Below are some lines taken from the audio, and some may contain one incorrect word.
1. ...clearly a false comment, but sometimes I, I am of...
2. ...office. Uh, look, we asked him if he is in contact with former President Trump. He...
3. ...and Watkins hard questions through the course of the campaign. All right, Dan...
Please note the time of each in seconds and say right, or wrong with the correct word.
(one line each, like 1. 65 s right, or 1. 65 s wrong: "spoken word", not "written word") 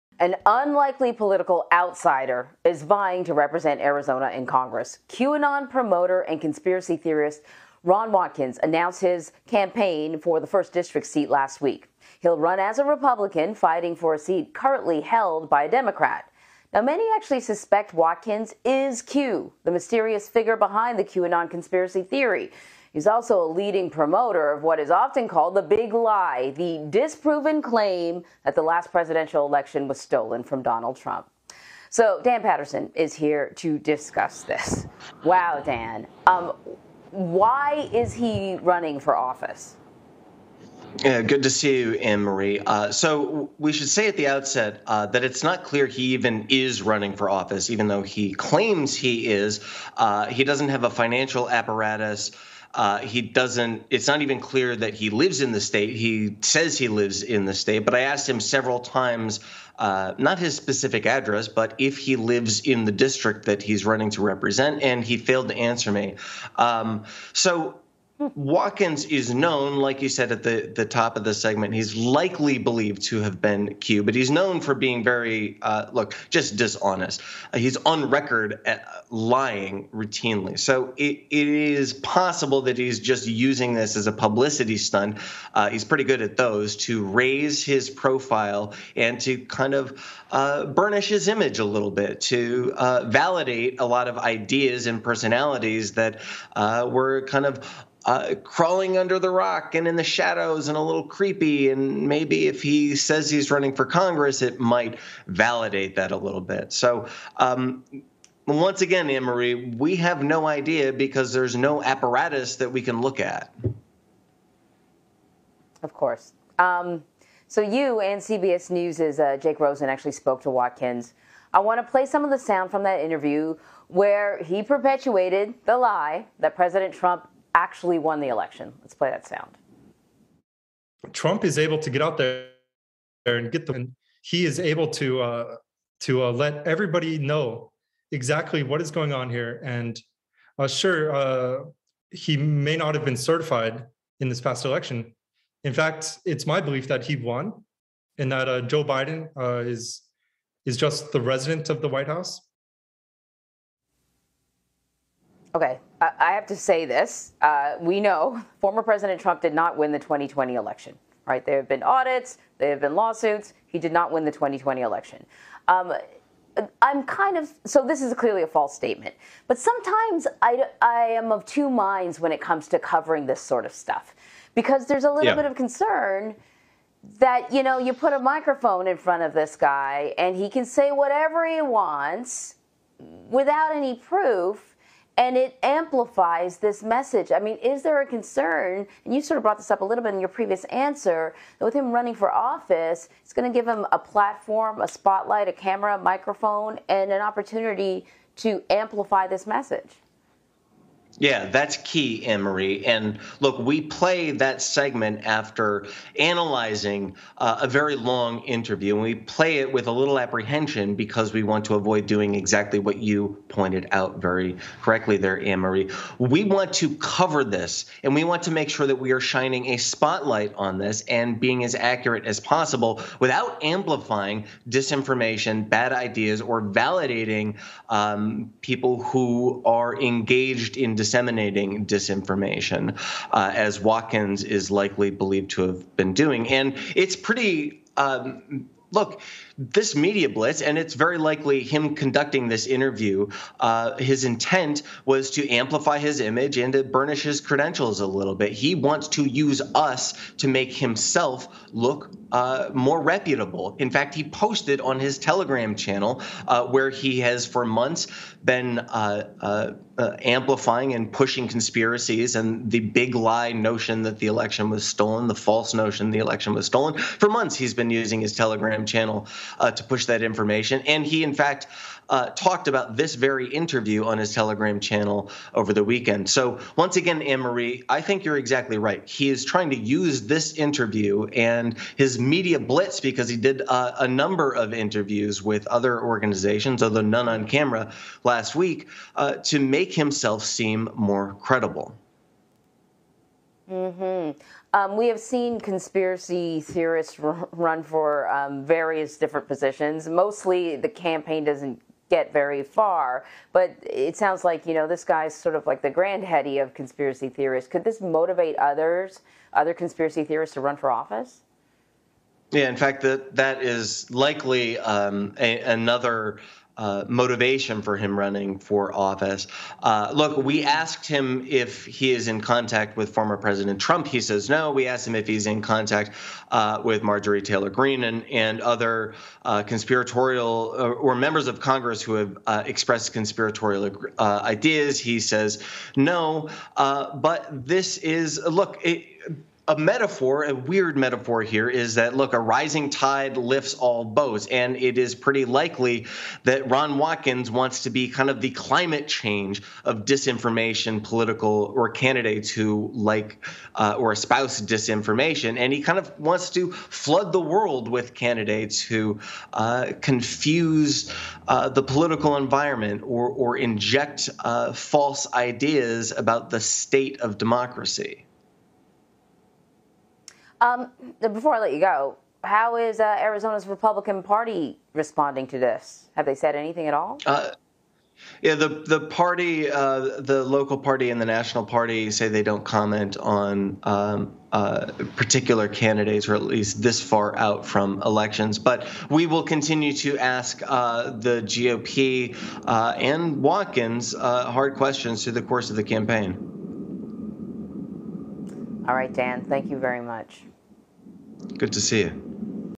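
1. 168 s wrong: "statement", not "comment"
2. 318 s right
3. 392 s right.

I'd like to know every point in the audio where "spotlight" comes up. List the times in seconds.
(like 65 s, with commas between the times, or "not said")
194 s, 219 s.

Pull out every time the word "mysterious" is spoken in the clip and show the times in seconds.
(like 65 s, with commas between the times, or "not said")
19 s.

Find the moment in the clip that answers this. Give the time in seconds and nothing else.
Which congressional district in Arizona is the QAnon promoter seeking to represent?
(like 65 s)
10 s.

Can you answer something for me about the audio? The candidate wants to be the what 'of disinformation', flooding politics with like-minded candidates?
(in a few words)
climate change.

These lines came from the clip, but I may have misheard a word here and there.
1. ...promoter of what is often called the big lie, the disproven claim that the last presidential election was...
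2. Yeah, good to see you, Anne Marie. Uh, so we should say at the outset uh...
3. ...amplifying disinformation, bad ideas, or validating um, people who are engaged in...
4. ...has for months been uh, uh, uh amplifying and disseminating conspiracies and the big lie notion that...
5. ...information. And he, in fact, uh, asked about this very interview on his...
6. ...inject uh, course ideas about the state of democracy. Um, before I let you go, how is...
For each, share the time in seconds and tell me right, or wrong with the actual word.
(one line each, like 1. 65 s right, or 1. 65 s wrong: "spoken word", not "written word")
1. 23 s right
2. 41 s right
3. 223 s right
4. 257 s wrong: "pushing", not "disseminating"
5. 270 s wrong: "talked", not "asked"
6. 363 s wrong: "false", not "course".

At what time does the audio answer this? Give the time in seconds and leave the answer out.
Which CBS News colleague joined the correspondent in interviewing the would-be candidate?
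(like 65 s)
119 s.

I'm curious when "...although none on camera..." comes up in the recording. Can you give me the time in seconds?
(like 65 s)
286 s.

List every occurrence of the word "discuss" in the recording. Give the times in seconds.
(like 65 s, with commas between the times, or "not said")
33 s.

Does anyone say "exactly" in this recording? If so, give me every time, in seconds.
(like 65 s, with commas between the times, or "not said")
138 s, 212 s, 278 s.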